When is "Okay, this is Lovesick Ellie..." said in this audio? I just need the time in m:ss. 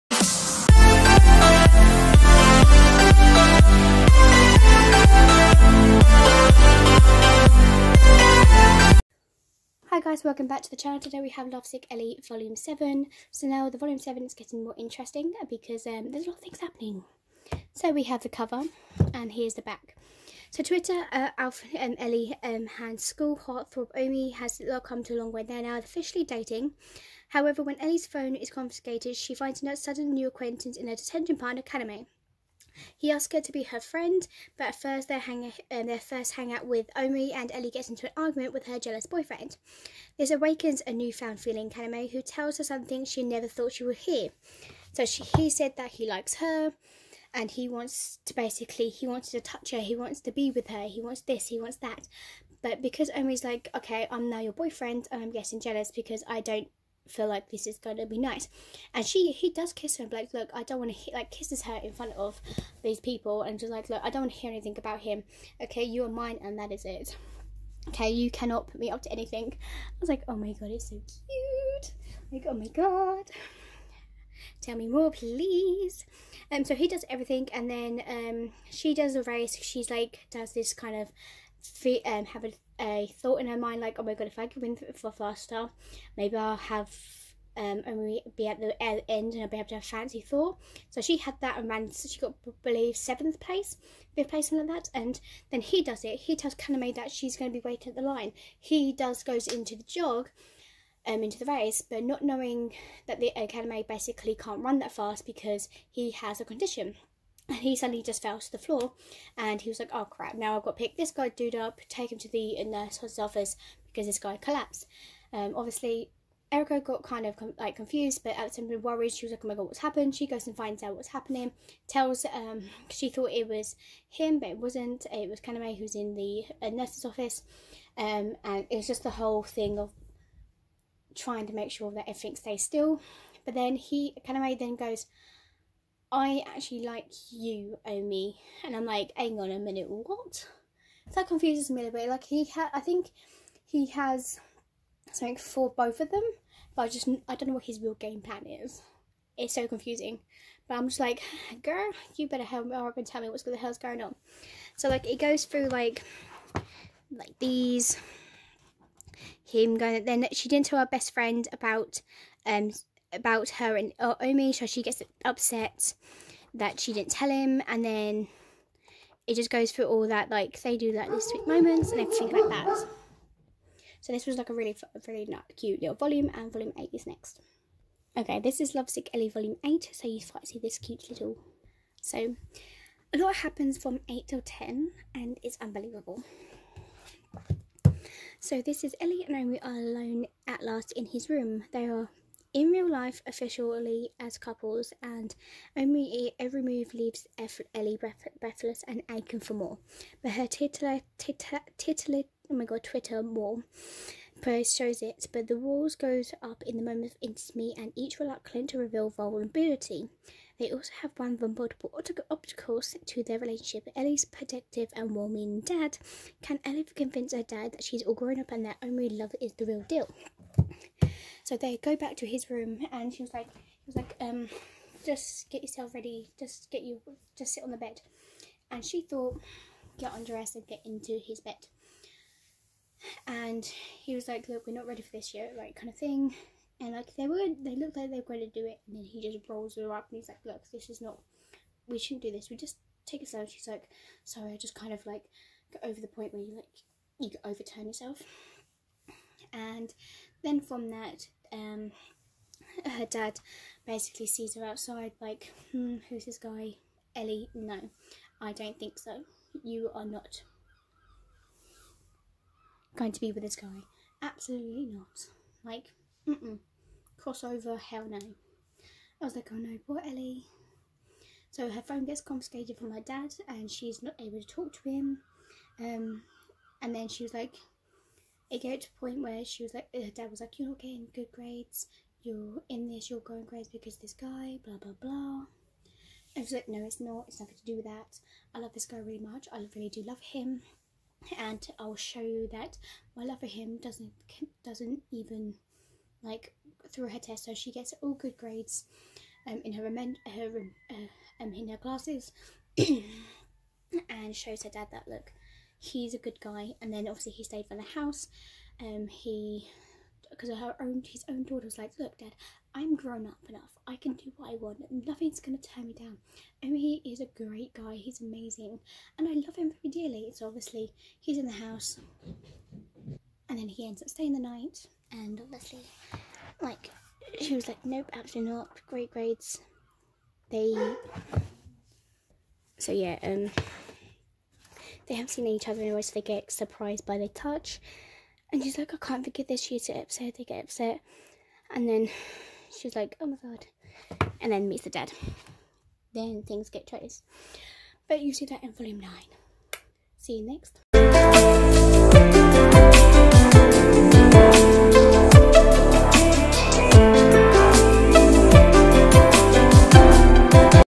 2:58.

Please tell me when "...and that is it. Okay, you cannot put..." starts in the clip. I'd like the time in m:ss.
1:06.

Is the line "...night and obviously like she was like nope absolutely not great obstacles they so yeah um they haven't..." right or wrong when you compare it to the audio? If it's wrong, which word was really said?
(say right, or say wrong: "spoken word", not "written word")
wrong: "grades", not "obstacles".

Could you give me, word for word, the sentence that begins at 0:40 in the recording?
This awakens a newfound feeling in Kaname, who tells her something she never thought she would hear.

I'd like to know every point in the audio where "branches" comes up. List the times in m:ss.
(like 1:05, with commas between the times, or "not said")
not said.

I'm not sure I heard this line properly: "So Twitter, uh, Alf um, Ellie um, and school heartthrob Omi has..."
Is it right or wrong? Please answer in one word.
right.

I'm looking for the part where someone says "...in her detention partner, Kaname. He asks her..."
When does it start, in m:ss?
0:30.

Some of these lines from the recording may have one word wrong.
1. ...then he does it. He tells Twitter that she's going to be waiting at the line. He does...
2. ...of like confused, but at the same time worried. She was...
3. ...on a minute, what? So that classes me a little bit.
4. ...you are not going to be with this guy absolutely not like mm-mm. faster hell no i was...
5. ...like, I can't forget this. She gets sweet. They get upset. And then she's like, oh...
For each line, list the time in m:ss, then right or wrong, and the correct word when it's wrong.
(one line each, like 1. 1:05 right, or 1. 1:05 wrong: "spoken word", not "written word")
1. 1:35 wrong: "Kaname", not "Twitter"
2. 1:57 right
3. 2:19 wrong: "confuses", not "classes"
4. 4:19 wrong: "crossover", not "faster"
5. 5:38 wrong: "upset", not "sweet".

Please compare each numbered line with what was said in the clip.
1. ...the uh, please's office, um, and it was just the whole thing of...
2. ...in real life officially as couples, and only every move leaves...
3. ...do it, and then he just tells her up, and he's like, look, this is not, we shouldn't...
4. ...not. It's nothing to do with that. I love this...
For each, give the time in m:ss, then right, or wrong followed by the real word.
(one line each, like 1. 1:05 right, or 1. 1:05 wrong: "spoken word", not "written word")
1. 2:06 wrong: "nurse", not "please"
2. 3:12 right
3. 3:58 wrong: "rolls", not "tells"
4. 4:47 right.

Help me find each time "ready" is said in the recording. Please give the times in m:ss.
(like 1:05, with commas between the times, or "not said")
3:45, 3:54.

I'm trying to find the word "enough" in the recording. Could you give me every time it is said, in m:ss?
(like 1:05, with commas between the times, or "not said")
5:13.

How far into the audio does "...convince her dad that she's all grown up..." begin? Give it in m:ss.
3:36.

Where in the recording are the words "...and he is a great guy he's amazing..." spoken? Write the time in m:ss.
5:16.